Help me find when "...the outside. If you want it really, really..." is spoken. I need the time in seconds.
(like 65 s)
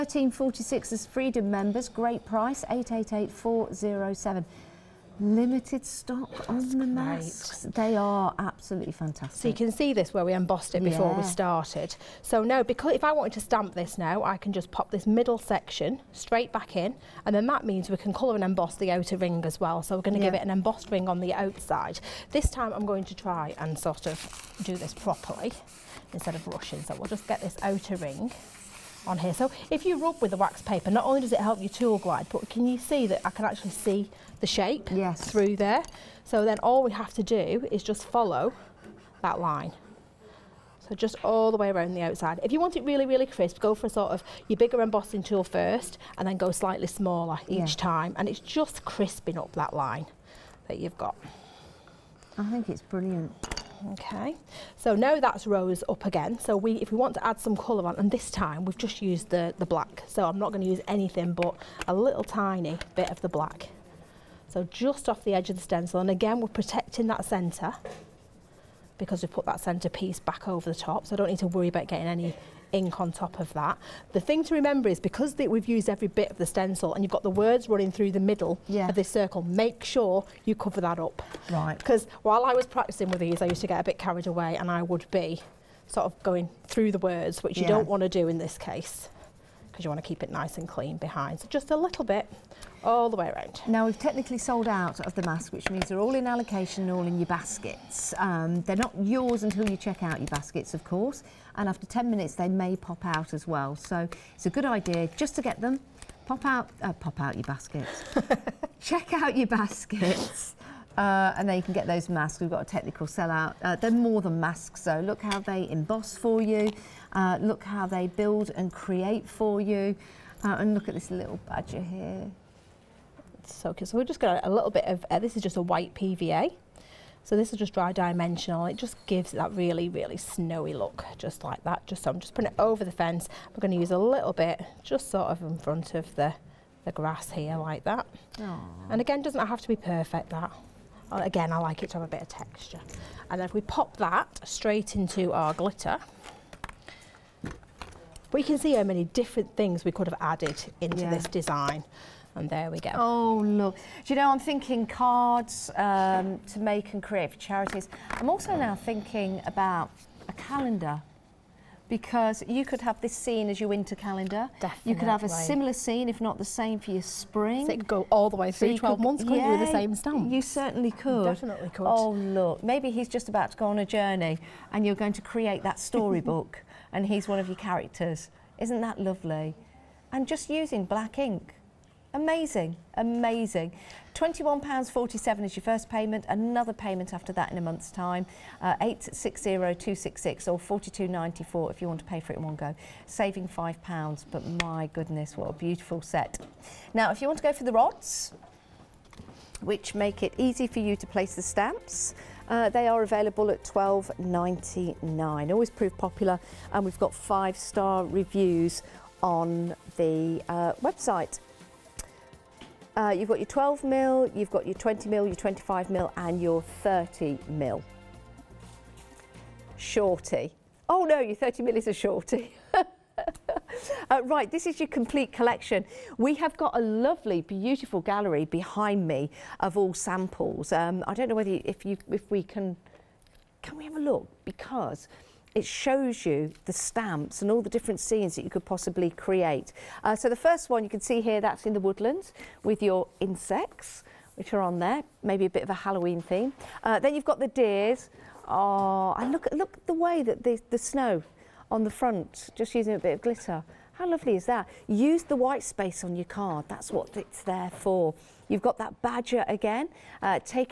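41 s.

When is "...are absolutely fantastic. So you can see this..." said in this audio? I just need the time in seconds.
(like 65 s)
7 s.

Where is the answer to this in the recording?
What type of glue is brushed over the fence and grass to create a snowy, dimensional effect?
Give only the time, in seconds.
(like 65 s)
125 s.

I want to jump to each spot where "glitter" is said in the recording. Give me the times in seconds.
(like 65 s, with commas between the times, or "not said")
145 s, 253 s.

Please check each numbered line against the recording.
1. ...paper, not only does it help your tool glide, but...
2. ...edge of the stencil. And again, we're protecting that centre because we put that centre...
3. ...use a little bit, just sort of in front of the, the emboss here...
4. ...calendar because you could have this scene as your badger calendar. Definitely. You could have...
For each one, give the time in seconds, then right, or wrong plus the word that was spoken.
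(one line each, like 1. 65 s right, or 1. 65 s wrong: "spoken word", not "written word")
1. 30 s right
2. 65 s right
3. 133 s wrong: "grass", not "emboss"
4. 160 s wrong: "winter", not "badger".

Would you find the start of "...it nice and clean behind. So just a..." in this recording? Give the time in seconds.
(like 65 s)
90 s.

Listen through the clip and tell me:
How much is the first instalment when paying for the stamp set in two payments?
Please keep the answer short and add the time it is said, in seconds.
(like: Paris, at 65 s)
£21.47, at 184 s.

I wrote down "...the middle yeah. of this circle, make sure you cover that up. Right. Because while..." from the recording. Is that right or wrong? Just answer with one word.
right.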